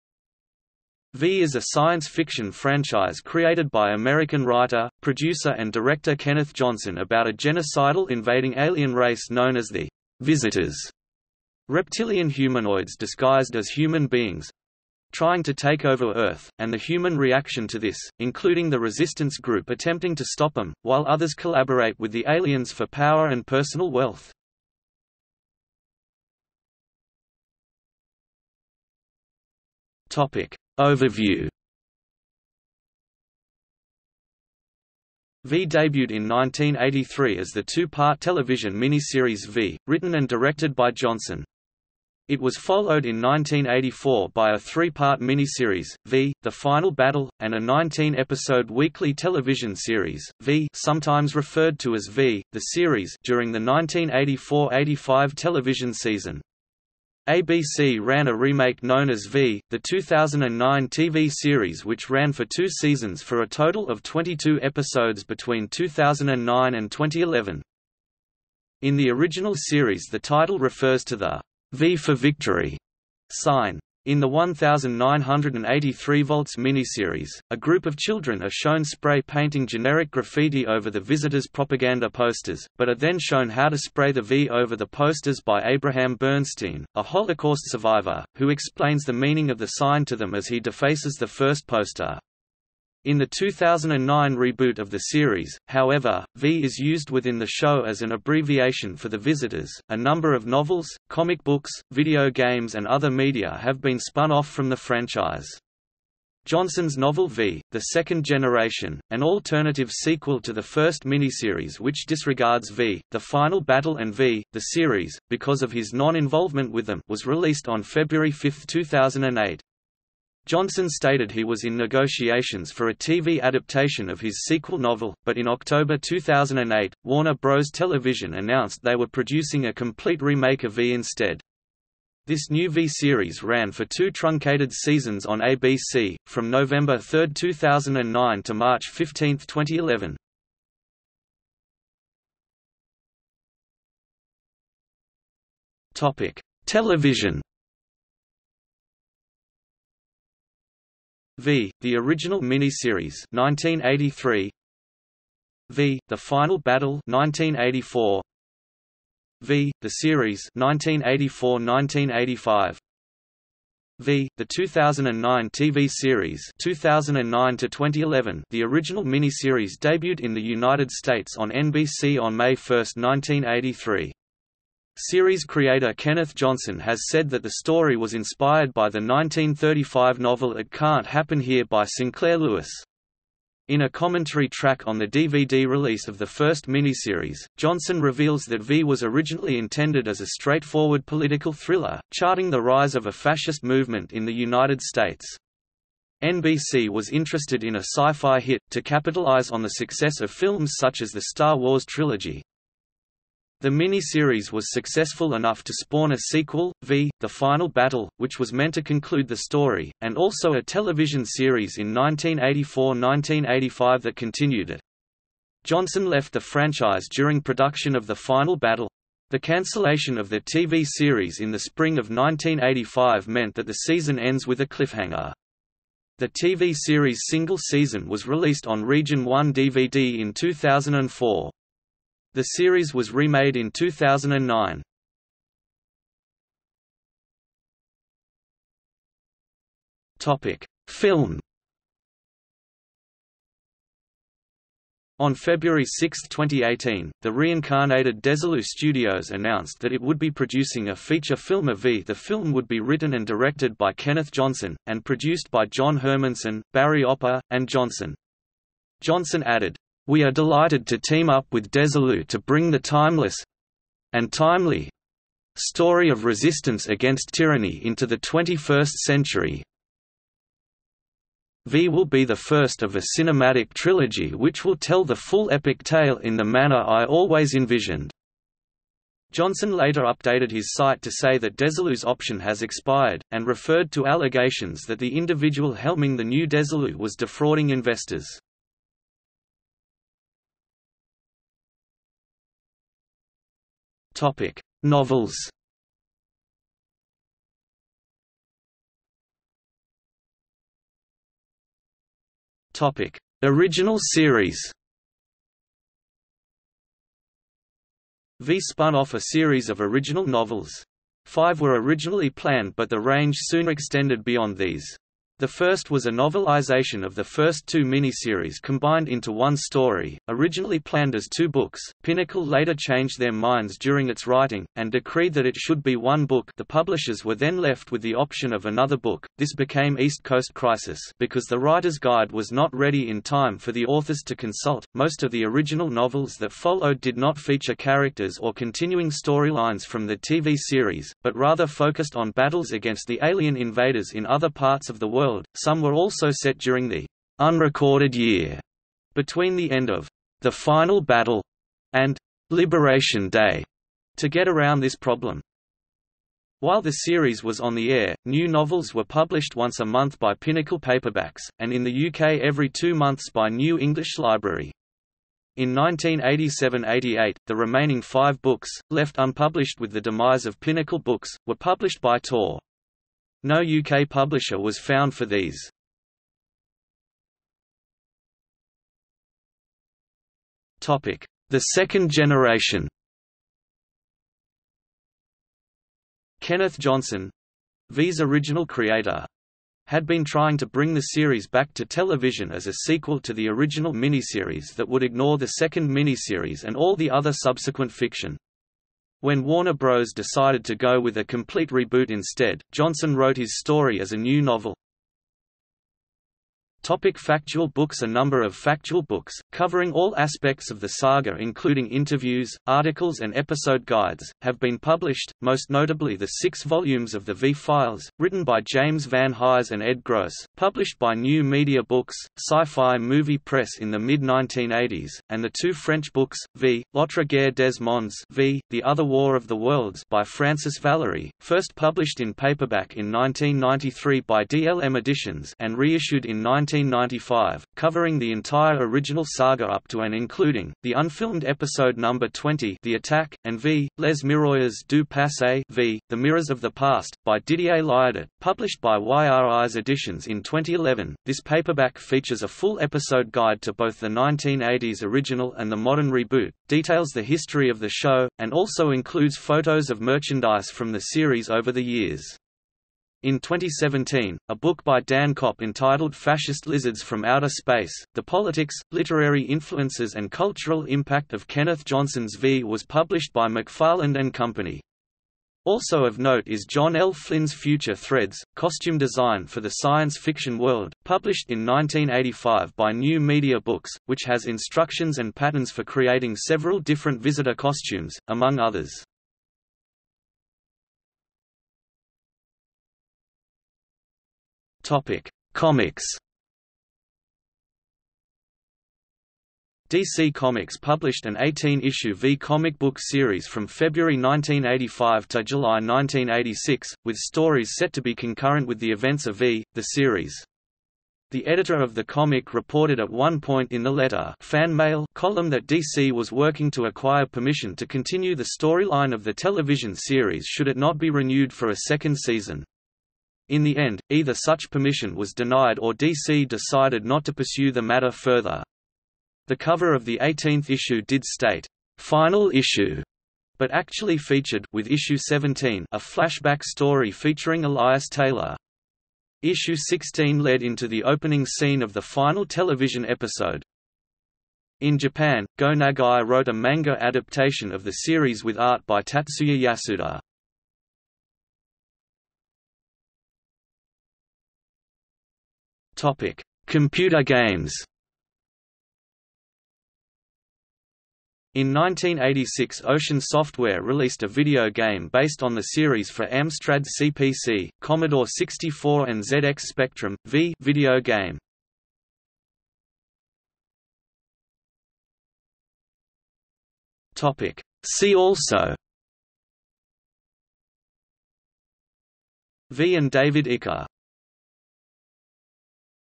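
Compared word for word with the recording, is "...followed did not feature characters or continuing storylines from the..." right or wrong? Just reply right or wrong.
right.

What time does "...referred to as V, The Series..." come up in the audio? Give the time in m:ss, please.
0:51.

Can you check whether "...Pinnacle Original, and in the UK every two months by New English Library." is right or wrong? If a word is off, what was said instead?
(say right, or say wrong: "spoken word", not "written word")
wrong: "Paperbacks", not "Original".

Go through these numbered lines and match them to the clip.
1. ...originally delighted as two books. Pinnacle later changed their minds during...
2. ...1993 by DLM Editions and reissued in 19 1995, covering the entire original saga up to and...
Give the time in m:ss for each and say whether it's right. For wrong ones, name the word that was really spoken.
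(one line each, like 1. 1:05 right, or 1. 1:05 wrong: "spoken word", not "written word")
1. 5:20 wrong: "planned", not "delighted"
2. 7:13 right.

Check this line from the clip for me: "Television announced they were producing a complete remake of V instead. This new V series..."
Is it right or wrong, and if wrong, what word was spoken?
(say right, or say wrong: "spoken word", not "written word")
right.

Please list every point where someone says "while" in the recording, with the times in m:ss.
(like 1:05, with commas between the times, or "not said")
0:20, 5:56.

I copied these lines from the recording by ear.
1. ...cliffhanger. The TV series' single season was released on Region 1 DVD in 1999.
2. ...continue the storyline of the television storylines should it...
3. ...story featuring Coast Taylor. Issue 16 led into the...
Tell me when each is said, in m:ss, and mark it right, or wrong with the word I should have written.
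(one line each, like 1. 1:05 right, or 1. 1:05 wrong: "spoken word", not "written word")
1. 3:44 wrong: "2004", not "1999"
2. 8:37 wrong: "series", not "storylines"
3. 8:56 wrong: "Elias", not "Coast".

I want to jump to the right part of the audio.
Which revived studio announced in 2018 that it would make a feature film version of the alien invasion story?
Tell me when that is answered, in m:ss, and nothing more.
4:08.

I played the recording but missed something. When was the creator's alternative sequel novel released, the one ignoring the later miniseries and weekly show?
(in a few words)
February 5, 2008.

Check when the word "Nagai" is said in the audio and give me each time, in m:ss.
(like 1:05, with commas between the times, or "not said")
9:05.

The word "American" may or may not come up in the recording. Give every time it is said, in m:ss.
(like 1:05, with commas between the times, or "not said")
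0:03.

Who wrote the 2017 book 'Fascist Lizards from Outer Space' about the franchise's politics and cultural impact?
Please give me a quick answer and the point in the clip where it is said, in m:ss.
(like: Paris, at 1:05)
Dan Copp, at 7:45.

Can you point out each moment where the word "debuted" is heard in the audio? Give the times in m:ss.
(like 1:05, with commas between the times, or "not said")
0:35, 2:49.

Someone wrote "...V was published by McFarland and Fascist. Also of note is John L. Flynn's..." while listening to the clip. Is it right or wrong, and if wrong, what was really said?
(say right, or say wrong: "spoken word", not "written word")
wrong: "Company", not "Fascist".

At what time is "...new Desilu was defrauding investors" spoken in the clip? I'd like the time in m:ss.
4:46.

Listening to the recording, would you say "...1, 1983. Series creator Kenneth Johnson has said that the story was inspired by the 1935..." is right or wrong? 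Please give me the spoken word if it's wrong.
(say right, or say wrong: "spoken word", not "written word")
right.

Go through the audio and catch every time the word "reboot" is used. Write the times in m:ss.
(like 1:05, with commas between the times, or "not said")
1:34, 6:41, 7:36.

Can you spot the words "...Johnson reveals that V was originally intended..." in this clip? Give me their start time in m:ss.
3:07.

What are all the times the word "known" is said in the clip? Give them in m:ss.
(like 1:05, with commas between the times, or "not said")
0:09, 0:58.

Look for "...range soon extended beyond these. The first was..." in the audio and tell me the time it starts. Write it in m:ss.
5:12.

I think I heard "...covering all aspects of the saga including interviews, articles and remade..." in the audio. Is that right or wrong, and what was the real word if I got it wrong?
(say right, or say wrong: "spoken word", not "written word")
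wrong: "episode", not "remade".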